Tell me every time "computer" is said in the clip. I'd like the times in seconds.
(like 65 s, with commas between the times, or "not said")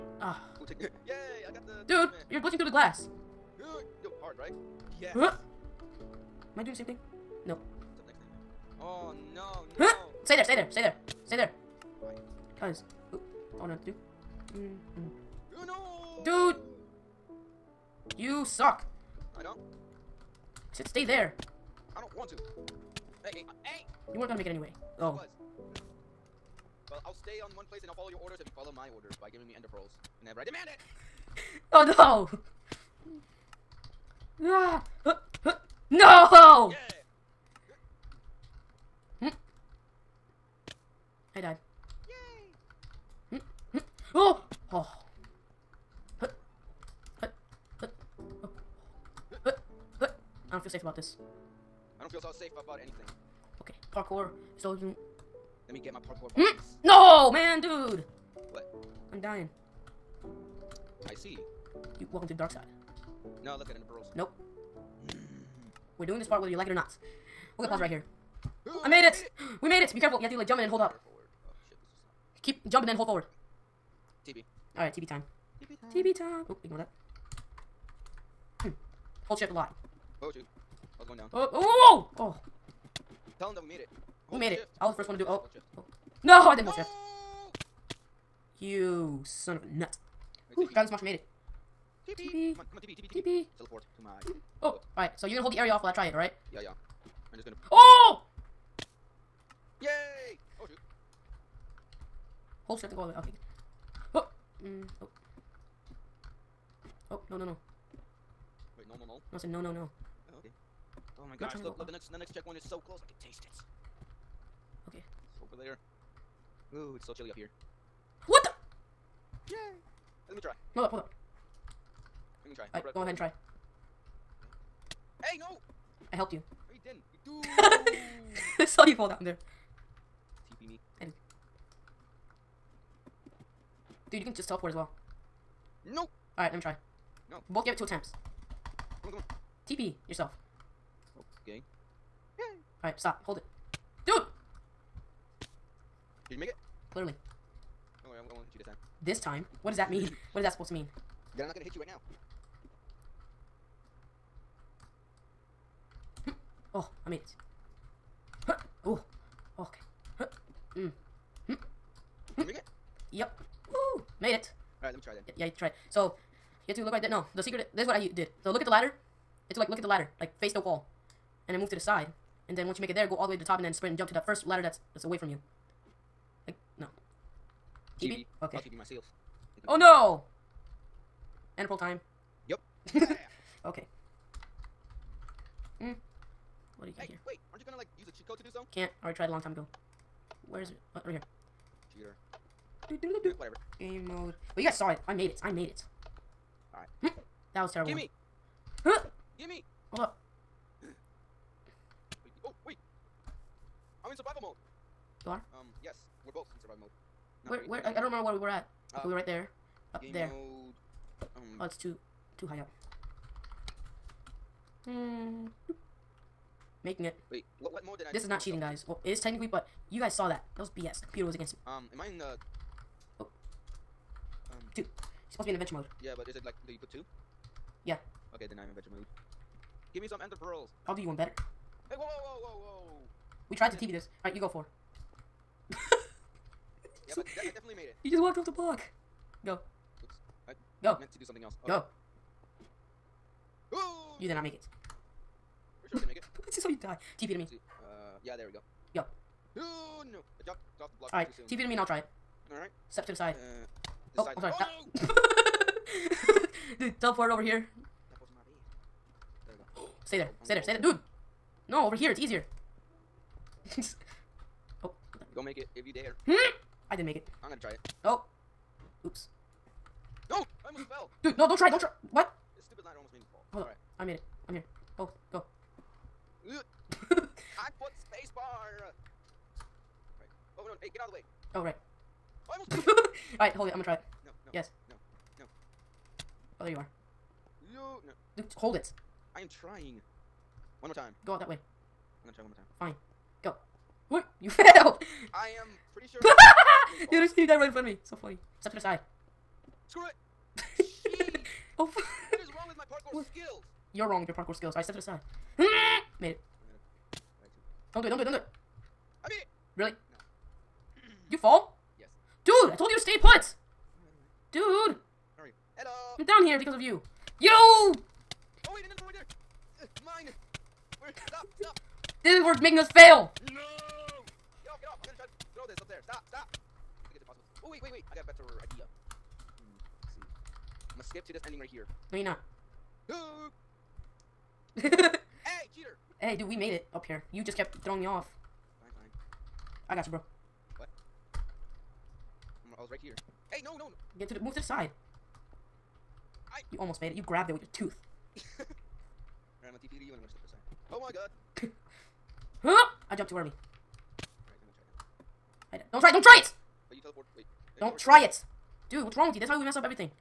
191 s, 221 s.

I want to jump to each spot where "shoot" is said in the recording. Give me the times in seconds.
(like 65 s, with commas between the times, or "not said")
80 s.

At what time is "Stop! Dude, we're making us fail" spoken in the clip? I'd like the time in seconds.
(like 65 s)
321 s.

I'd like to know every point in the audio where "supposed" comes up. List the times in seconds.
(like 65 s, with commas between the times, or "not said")
150 s, 225 s.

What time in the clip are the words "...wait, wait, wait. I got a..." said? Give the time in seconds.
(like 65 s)
327 s.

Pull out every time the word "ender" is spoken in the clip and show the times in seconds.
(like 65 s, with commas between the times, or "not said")
29 s, 230 s.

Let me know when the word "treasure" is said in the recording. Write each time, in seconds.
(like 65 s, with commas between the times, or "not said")
not said.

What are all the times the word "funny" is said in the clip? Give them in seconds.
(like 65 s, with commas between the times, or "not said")
298 s.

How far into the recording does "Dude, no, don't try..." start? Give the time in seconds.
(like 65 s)
271 s.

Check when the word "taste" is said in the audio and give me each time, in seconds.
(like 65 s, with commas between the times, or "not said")
113 s.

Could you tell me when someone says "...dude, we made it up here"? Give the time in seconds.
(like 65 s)
336 s.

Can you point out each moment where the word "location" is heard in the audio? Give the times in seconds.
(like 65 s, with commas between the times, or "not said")
not said.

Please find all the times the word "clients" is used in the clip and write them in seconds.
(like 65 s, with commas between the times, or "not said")
not said.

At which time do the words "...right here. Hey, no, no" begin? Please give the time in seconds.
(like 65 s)
342 s.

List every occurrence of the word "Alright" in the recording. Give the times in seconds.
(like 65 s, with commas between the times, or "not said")
74 s, 122 s, 196 s, 234 s, 304 s, 348 s.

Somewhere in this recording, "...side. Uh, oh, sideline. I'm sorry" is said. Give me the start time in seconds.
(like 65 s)
253 s.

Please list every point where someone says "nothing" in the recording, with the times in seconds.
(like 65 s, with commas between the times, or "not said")
not said.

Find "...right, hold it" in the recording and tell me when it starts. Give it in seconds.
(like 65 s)
283 s.